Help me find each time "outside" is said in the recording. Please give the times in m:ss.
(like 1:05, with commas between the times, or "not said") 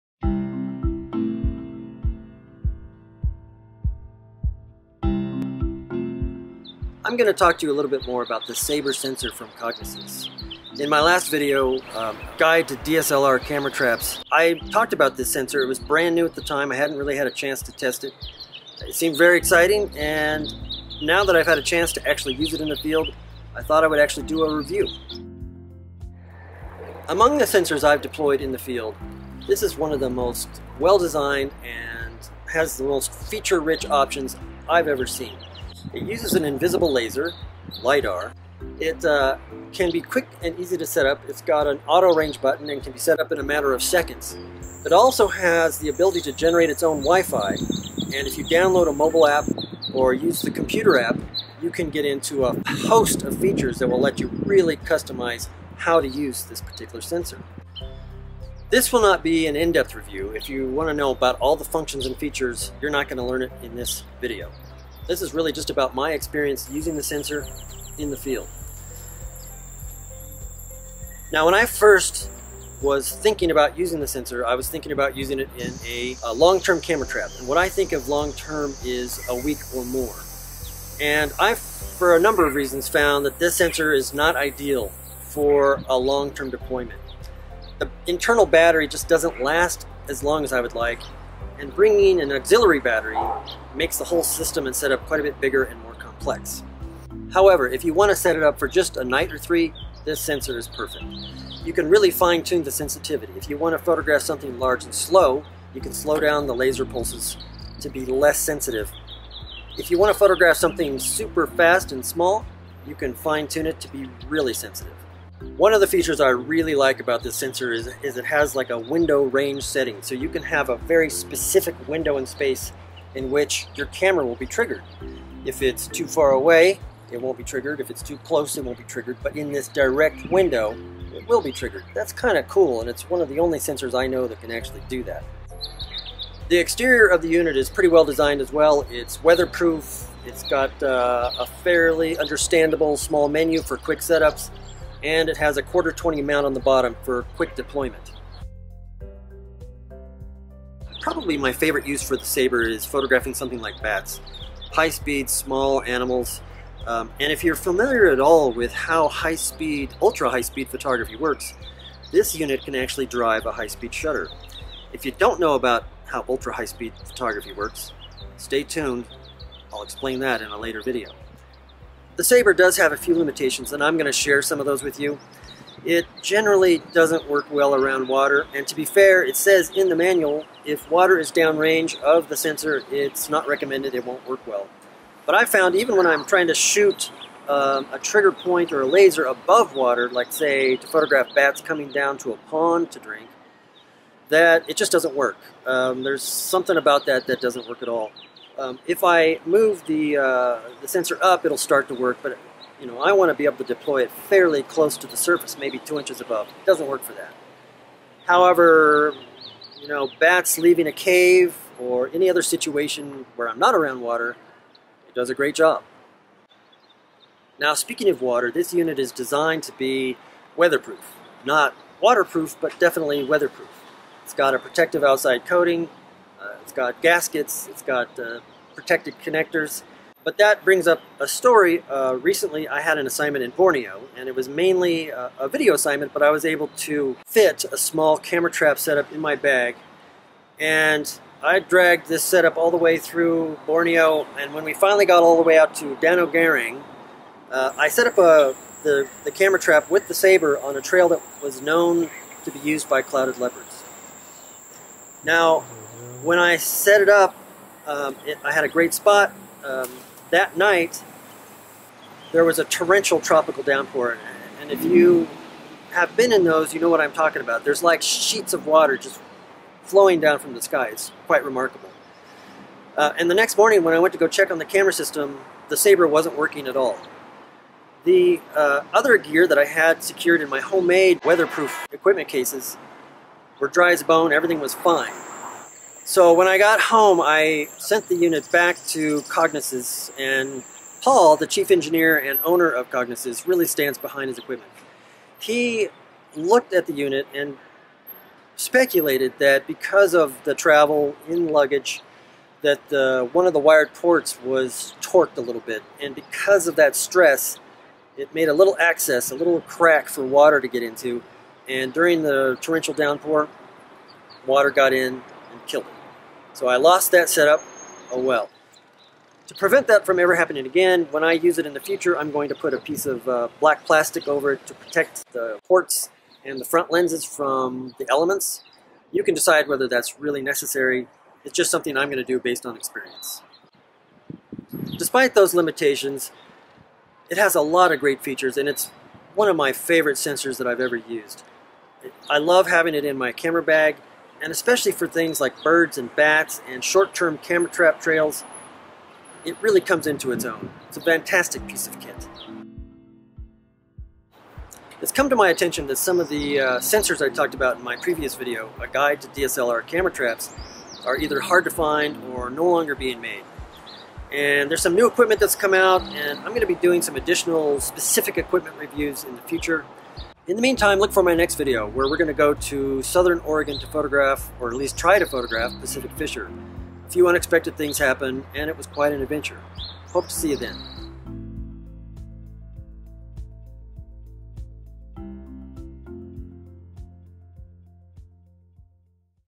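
3:45.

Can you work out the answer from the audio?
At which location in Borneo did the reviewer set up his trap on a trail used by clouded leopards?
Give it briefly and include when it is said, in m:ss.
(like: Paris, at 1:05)
Danau Girang, at 4:05.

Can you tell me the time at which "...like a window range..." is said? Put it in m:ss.
1:58.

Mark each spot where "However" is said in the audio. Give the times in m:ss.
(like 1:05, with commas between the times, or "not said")
1:37, 3:28.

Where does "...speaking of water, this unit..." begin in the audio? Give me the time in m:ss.
3:37.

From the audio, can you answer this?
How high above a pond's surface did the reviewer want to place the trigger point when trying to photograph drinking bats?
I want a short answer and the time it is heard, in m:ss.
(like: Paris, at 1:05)
2 inches, at 3:25.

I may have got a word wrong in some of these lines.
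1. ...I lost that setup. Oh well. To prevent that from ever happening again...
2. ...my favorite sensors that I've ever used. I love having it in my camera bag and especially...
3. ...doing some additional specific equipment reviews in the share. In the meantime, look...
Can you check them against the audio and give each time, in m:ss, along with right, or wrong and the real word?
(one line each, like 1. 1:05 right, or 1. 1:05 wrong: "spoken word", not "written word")
1. 5:16 right
2. 5:39 right
3. 6:06 wrong: "future", not "share".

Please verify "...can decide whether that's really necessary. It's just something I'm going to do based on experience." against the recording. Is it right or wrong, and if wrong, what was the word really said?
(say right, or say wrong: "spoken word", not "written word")
right.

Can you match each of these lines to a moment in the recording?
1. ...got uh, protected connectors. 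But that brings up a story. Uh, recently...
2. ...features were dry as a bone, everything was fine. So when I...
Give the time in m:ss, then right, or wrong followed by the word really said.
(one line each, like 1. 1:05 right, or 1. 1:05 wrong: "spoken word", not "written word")
1. 3:47 right
2. 4:42 wrong: "cases", not "features".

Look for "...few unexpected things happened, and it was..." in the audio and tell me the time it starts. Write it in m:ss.
6:17.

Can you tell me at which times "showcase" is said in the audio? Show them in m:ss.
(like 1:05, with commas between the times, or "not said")
not said.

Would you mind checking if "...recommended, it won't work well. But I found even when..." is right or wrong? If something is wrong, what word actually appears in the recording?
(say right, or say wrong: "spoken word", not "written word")
right.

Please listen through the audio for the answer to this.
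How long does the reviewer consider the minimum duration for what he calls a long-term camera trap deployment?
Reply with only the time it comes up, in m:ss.
1:19.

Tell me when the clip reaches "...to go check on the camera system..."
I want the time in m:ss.
4:34.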